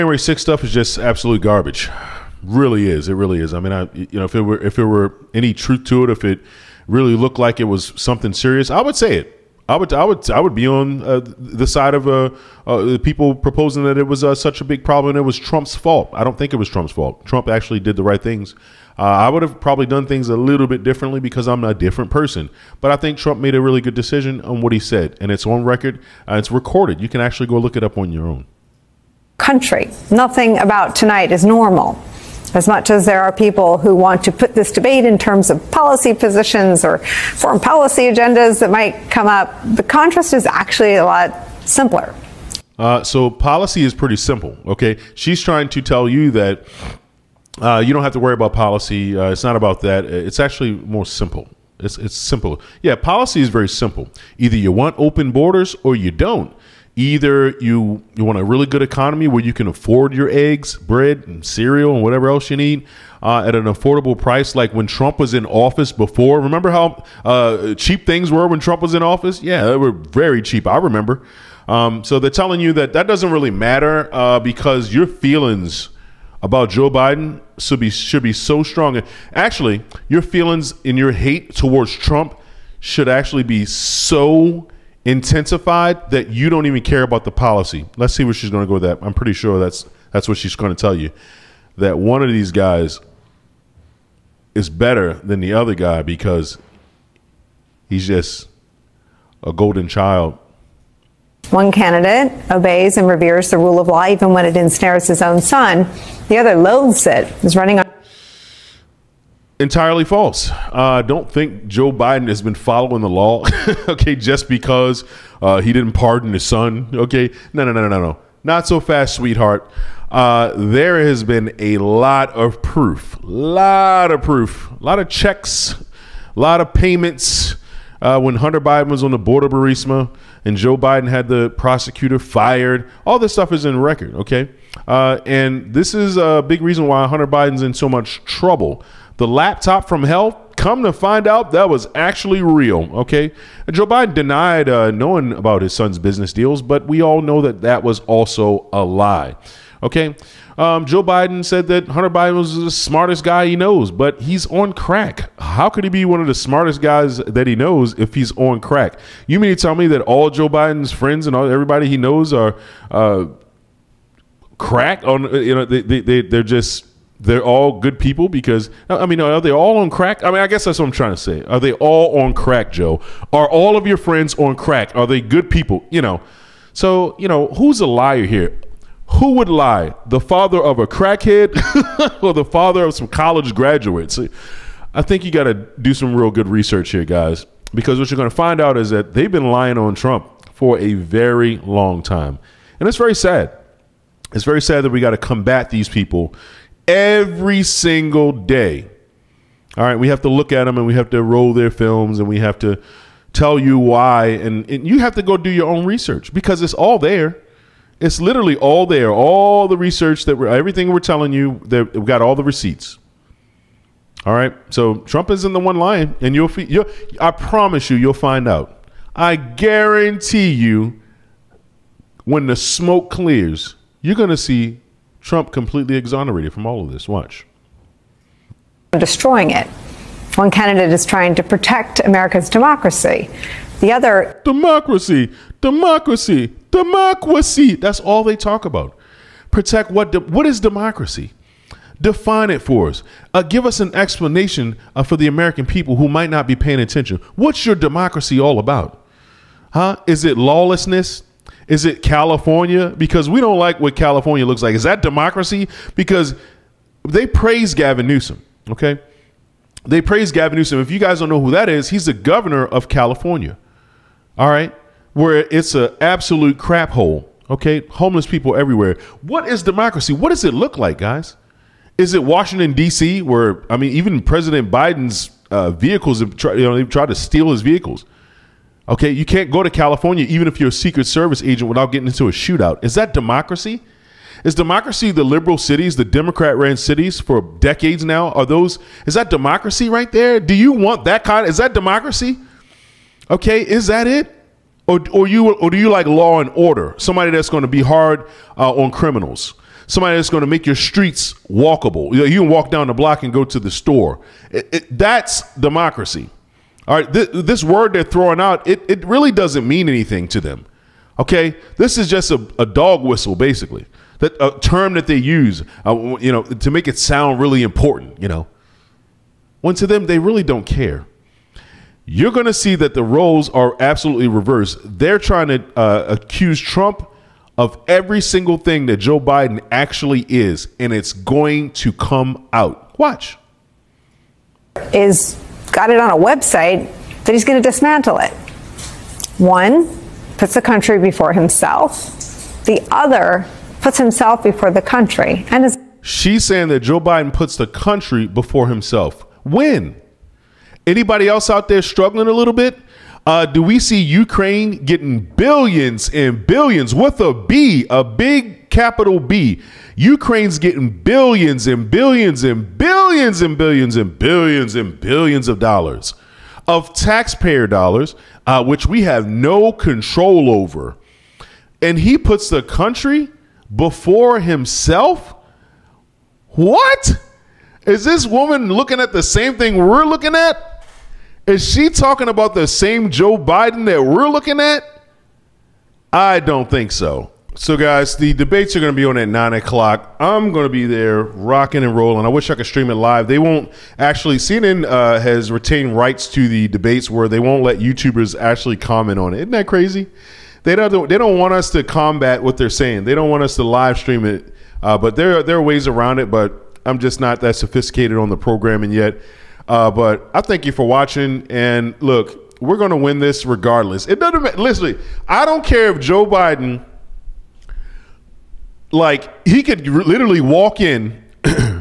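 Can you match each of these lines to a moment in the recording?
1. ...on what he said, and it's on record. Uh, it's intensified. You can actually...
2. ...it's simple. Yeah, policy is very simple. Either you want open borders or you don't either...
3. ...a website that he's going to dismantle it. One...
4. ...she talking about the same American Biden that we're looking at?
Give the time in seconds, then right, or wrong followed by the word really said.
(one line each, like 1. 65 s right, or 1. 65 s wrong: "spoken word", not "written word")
1. 24 s wrong: "recorded", not "intensified"
2. 51 s right
3. 336 s right
4. 381 s wrong: "Joe", not "American".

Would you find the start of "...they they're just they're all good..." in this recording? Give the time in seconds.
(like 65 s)
166 s.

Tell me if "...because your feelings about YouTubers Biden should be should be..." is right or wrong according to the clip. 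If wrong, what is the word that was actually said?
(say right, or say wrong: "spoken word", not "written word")
wrong: "Joe", not "YouTubers".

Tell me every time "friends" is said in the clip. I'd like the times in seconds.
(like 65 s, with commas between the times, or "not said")
160 s, 173 s.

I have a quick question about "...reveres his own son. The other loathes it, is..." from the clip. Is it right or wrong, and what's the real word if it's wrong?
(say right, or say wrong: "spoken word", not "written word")
wrong: "ensnares", not "reveres".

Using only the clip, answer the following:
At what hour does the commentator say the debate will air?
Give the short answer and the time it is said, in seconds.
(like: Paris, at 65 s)
9 o'clock, at 389 s.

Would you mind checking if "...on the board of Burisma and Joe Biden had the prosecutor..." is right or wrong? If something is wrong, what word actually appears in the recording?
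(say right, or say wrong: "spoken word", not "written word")
right.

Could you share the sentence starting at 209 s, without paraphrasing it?
All the research that we're, everything we're telling you, that we've got all the receipts.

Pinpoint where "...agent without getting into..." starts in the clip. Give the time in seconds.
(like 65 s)
281 s.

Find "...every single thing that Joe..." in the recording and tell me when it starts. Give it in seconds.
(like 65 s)
327 s.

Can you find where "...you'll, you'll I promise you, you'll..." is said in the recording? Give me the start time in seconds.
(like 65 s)
216 s.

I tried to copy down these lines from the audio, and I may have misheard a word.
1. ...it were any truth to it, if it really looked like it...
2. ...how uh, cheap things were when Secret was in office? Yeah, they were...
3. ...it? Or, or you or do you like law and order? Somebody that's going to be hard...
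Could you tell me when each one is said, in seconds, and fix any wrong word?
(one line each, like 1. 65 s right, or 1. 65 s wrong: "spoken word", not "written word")
1. 4 s right
2. 66 s wrong: "Trump", not "Secret"
3. 294 s right.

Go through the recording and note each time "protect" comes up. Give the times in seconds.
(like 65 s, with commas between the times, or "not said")
231 s, 239 s.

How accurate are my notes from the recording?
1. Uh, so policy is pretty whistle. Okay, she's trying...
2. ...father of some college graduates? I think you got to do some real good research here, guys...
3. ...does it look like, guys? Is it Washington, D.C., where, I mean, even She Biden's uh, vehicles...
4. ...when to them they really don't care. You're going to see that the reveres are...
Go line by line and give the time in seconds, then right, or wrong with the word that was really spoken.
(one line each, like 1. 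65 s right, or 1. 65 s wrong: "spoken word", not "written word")
1. 42 s wrong: "simple", not "whistle"
2. 182 s right
3. 270 s wrong: "President", not "She"
4. 319 s wrong: "roles", not "reveres".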